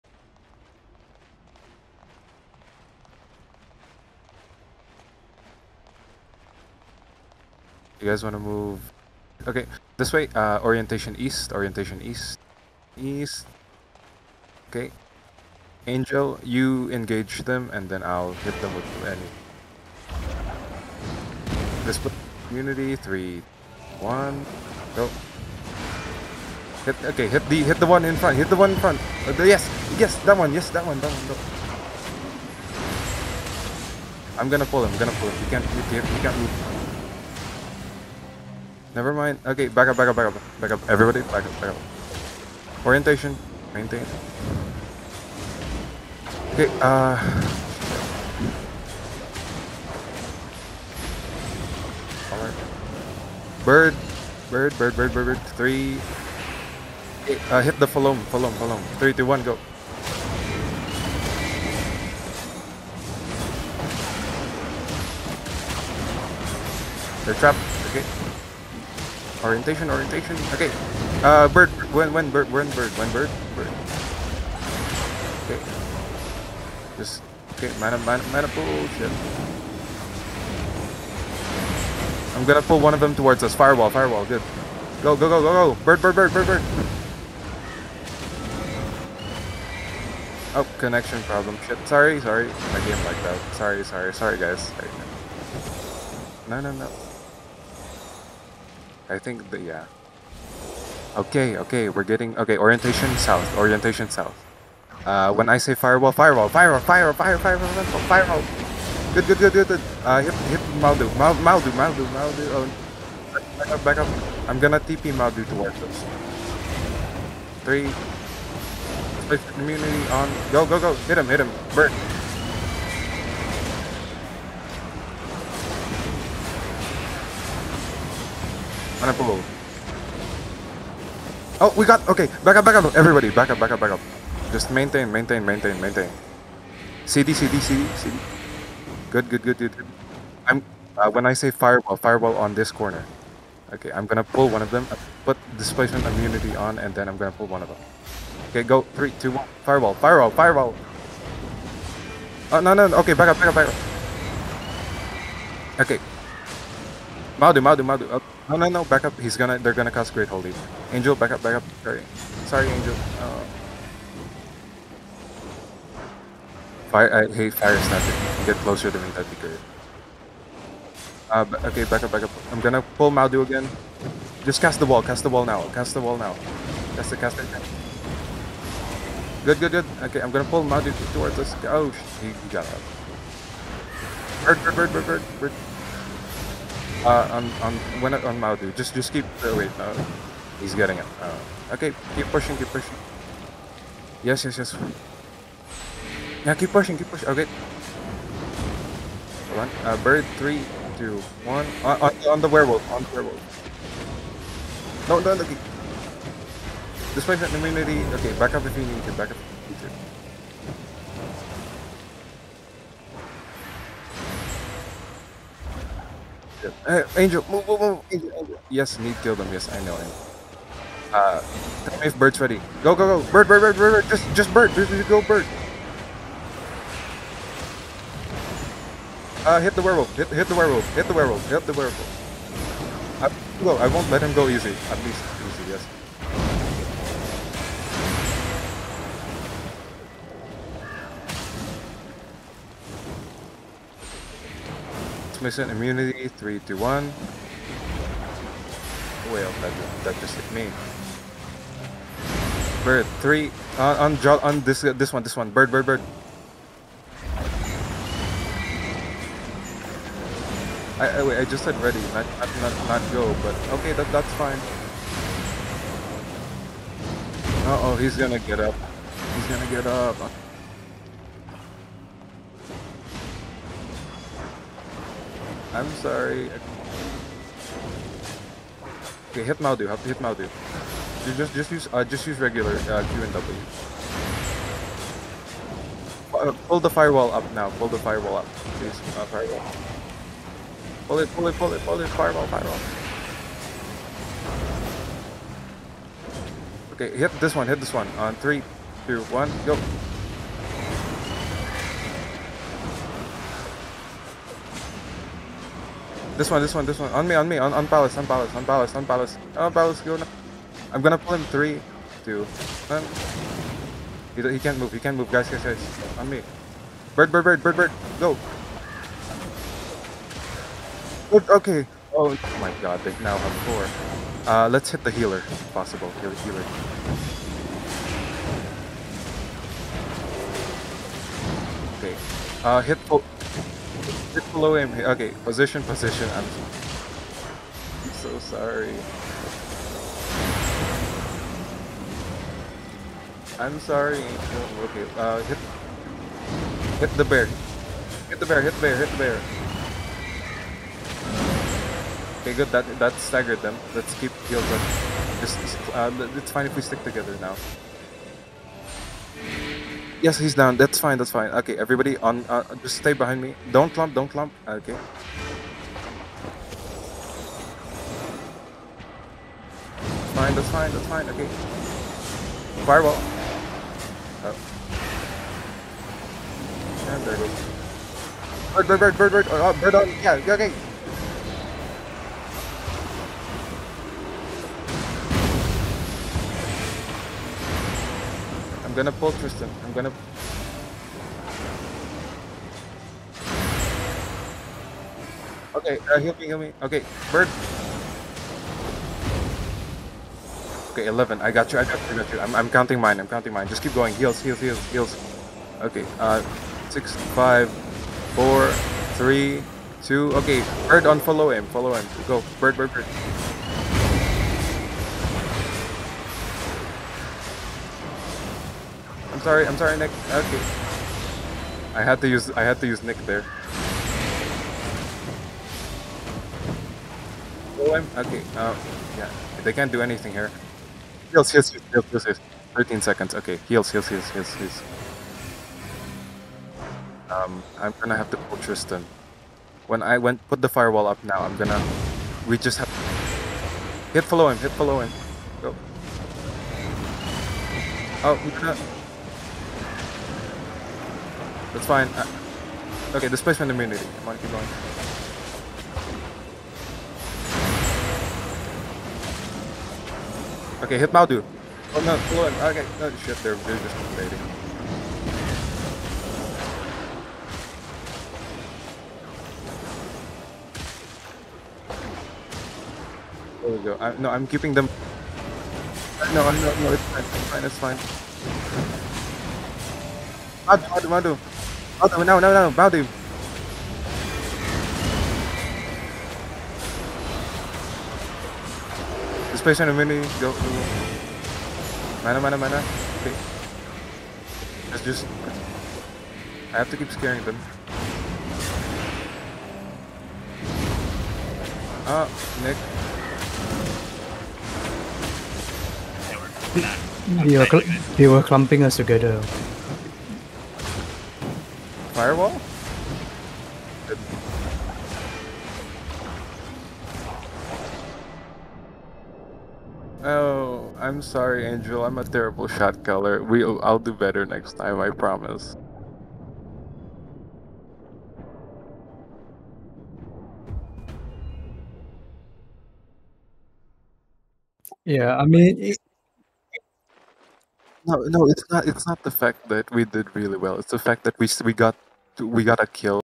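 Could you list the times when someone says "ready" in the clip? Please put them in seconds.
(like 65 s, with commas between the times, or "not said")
222 s, 261 s.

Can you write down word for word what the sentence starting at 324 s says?
Uh, let's hit the healer, if possible.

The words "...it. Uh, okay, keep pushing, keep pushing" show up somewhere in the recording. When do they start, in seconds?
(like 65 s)
190 s.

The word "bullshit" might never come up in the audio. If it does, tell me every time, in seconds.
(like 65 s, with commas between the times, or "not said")
78 s.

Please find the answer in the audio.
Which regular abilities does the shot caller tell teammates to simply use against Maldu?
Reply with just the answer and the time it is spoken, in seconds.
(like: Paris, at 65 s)
Q and W, at 283 s.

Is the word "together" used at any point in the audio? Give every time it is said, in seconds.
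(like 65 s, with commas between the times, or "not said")
357 s, 508 s.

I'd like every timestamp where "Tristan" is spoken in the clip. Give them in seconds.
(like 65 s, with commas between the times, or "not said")
389 s, 438 s.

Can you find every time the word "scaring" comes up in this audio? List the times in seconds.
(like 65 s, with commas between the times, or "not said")
497 s.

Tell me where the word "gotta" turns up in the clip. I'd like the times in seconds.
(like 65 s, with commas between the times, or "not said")
542 s.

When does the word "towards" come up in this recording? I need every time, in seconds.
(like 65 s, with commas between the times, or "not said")
83 s, 115 s, 181 s.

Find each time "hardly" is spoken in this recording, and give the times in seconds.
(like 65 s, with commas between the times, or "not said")
not said.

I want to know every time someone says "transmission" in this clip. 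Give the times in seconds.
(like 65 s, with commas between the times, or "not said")
245 s.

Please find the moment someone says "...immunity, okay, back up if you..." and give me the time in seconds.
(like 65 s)
207 s.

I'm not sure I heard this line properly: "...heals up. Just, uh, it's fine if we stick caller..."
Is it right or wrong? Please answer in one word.
wrong.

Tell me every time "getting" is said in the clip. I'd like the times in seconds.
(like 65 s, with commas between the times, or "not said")
102 s, 190 s.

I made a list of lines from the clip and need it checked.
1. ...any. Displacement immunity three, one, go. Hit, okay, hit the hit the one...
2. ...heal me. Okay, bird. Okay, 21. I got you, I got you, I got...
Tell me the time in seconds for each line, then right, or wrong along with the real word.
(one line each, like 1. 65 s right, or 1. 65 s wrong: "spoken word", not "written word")
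1. 19 s right
2. 396 s wrong: "11", not "21".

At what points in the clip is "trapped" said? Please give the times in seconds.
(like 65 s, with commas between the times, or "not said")
67 s.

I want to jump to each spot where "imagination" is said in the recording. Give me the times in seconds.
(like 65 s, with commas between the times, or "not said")
not said.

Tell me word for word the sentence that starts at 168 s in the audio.
Get closer to me, that'd be great.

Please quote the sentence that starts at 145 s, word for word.
Put displacement immunity on, and then I'm gonna pull one of them.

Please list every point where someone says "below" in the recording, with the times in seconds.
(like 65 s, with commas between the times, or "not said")
334 s.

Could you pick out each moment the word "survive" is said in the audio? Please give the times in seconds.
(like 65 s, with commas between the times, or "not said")
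not said.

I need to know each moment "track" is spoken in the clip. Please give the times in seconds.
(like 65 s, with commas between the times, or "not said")
not said.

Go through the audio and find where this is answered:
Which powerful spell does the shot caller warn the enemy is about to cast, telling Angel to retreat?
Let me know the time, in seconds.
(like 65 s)
160 s.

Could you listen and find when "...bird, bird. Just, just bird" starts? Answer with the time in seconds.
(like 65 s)
223 s.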